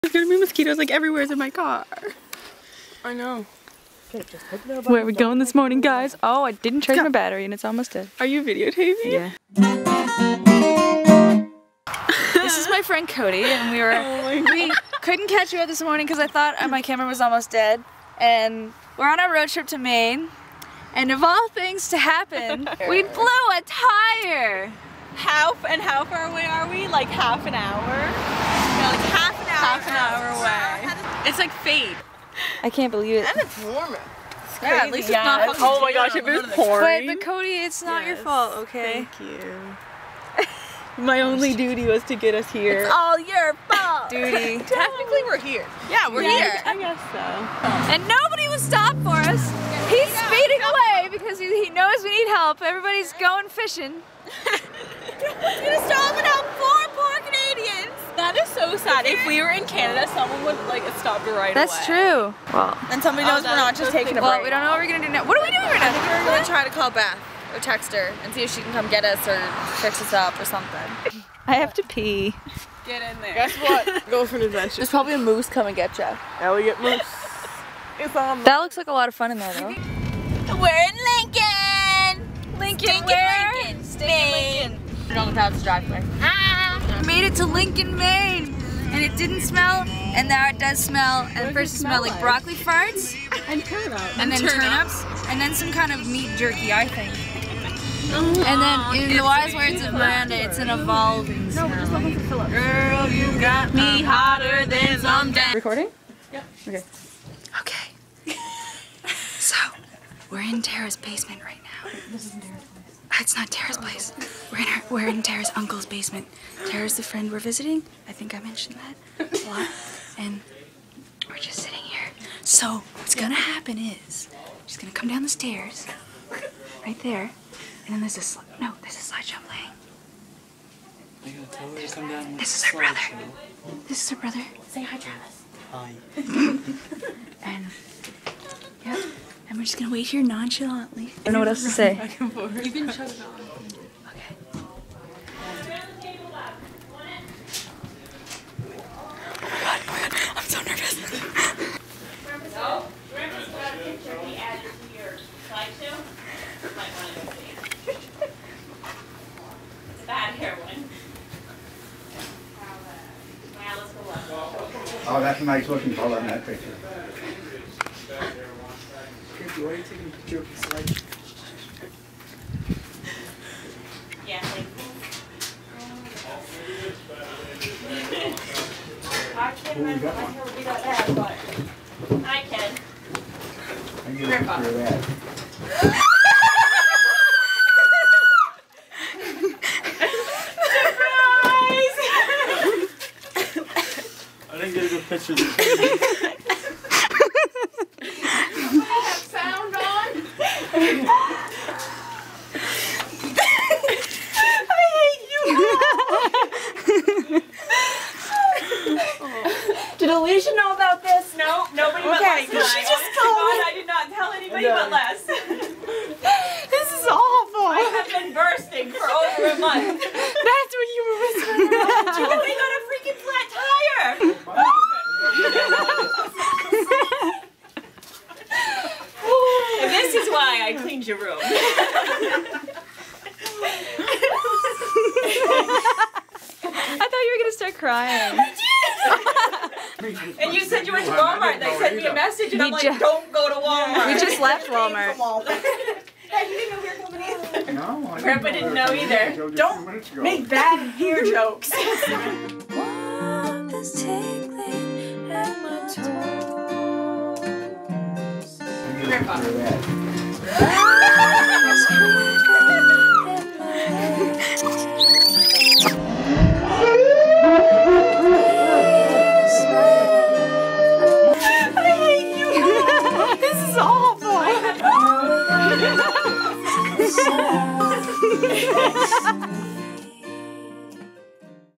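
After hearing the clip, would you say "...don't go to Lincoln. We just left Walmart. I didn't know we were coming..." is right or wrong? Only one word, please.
wrong.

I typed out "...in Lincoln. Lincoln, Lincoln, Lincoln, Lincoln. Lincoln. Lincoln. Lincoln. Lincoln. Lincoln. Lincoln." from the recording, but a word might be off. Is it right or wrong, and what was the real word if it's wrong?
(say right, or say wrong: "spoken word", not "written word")
right.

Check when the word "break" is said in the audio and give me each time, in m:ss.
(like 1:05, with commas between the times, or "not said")
1:04.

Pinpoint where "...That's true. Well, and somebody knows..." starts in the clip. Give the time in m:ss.
1:01.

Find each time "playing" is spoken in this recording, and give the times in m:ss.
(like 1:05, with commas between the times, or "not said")
2:09.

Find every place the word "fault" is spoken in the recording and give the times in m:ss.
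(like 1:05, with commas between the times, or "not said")
0:38, 0:43.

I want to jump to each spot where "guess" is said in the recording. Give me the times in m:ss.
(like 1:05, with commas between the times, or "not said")
0:46, 1:13.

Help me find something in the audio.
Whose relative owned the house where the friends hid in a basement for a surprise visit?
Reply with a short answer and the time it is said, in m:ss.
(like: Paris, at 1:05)
Tara's uncle, at 1:55.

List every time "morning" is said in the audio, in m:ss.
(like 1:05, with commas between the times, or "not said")
0:05, 0:15.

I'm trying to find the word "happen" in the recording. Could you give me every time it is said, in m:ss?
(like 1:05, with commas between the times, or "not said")
0:21, 2:03.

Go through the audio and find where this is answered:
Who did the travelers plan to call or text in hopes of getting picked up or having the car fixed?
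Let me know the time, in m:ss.
1:06.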